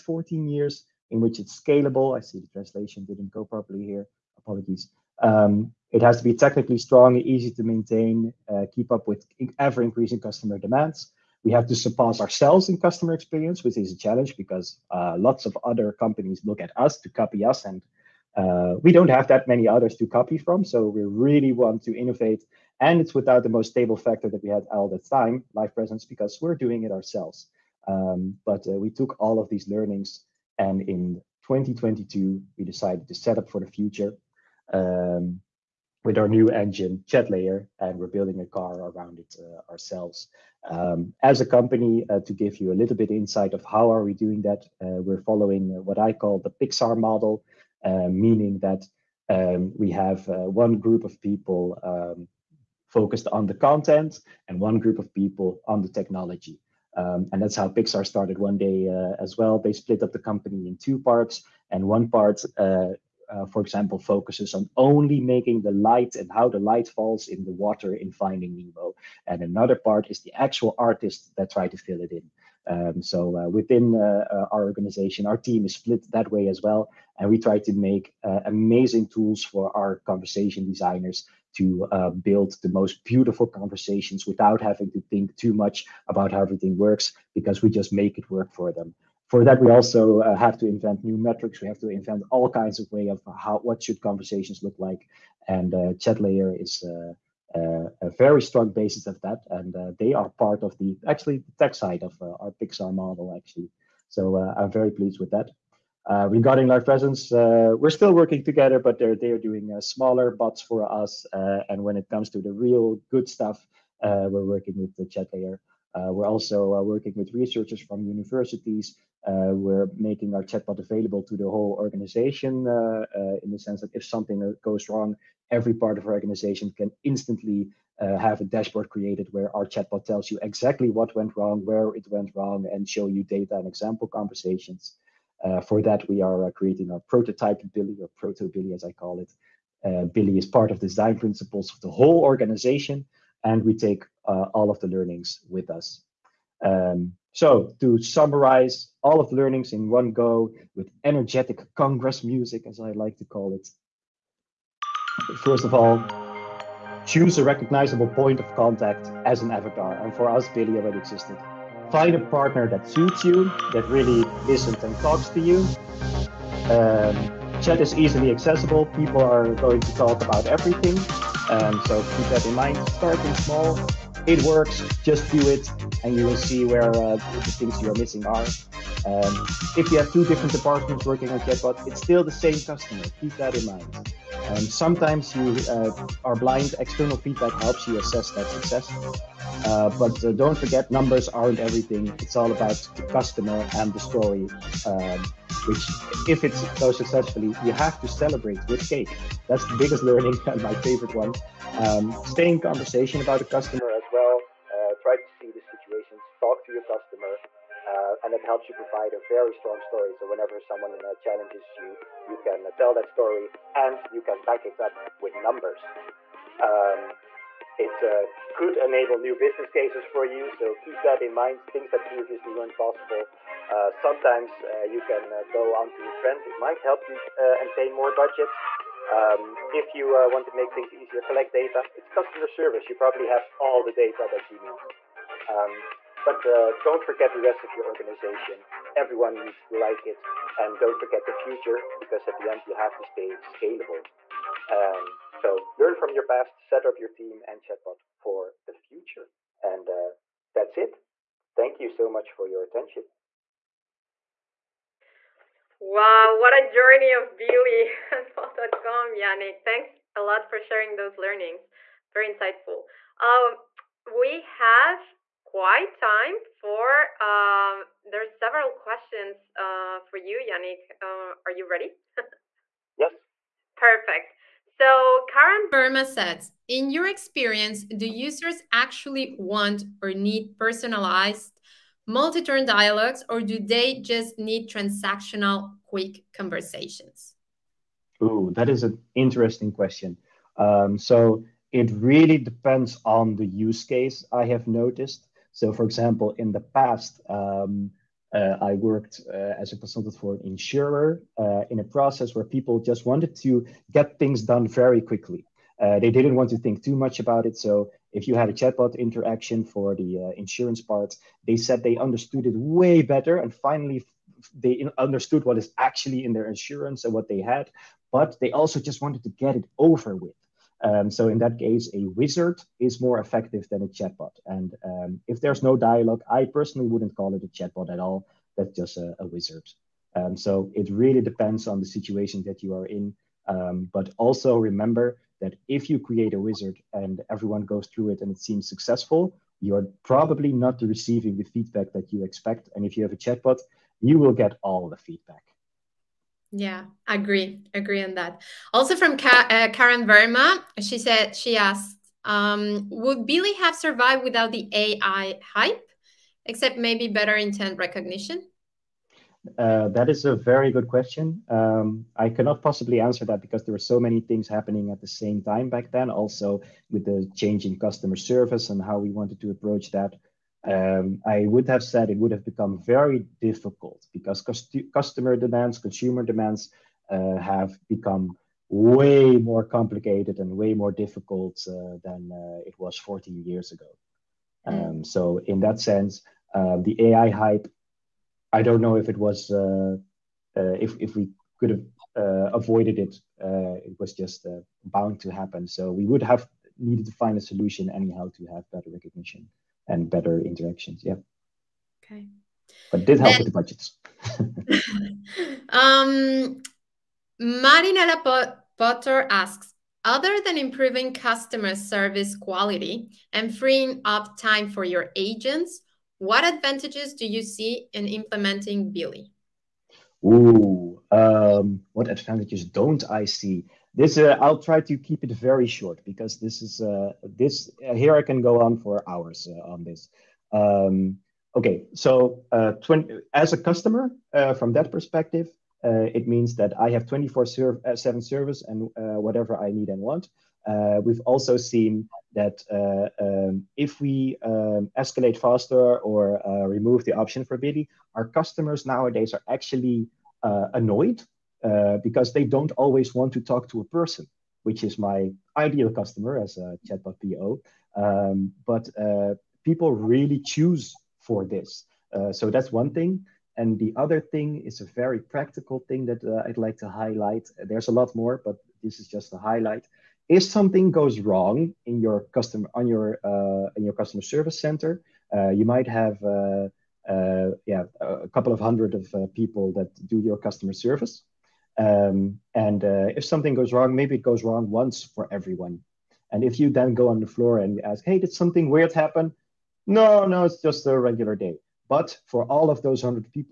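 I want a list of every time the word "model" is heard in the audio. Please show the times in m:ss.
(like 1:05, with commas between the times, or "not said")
0:46, 1:42.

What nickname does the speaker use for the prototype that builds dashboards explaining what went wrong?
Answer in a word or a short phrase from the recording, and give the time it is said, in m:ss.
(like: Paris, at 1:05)
Proto Billie, at 2:18.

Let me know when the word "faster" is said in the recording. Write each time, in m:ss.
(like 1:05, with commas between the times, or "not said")
7:25.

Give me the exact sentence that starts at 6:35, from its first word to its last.
So, we would have needed to find a solution anyhow to have better recognition and better interactions.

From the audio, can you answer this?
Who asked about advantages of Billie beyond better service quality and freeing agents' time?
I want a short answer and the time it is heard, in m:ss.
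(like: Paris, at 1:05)
Marinella Potter, at 6:47.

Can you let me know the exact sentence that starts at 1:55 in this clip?
Uh, we're also uh, working with researchers from universities.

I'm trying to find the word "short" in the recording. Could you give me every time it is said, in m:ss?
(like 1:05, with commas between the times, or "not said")
7:05.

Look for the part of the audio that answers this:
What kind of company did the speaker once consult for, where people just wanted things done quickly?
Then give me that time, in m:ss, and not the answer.
5:00.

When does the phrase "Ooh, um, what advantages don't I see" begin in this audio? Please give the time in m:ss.
7:00.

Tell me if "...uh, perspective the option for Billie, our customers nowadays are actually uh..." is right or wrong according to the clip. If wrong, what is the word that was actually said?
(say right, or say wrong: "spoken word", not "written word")
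wrong: "remove", not "perspective".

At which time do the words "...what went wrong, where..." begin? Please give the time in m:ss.
2:10.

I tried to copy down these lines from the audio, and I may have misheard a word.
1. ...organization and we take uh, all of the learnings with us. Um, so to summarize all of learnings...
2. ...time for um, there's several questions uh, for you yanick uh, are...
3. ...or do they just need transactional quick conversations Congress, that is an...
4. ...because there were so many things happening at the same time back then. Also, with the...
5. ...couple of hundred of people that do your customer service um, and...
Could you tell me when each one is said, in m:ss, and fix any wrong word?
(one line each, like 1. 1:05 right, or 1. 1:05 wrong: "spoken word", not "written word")
1. 2:22 right
2. 4:25 right
3. 4:43 wrong: "Ooh", not "Congress"
4. 6:03 right
5. 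7:58 right.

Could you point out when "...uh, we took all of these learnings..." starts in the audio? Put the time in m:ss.
0:28.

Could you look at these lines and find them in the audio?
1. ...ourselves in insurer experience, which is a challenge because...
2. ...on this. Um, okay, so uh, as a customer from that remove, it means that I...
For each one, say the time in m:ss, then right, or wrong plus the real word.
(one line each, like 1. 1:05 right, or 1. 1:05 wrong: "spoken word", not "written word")
1. 0:12 wrong: "customer", not "insurer"
2. 7:09 wrong: "perspective", not "remove".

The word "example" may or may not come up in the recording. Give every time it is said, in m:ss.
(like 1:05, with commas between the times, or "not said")
1:03, 2:13, 4:55.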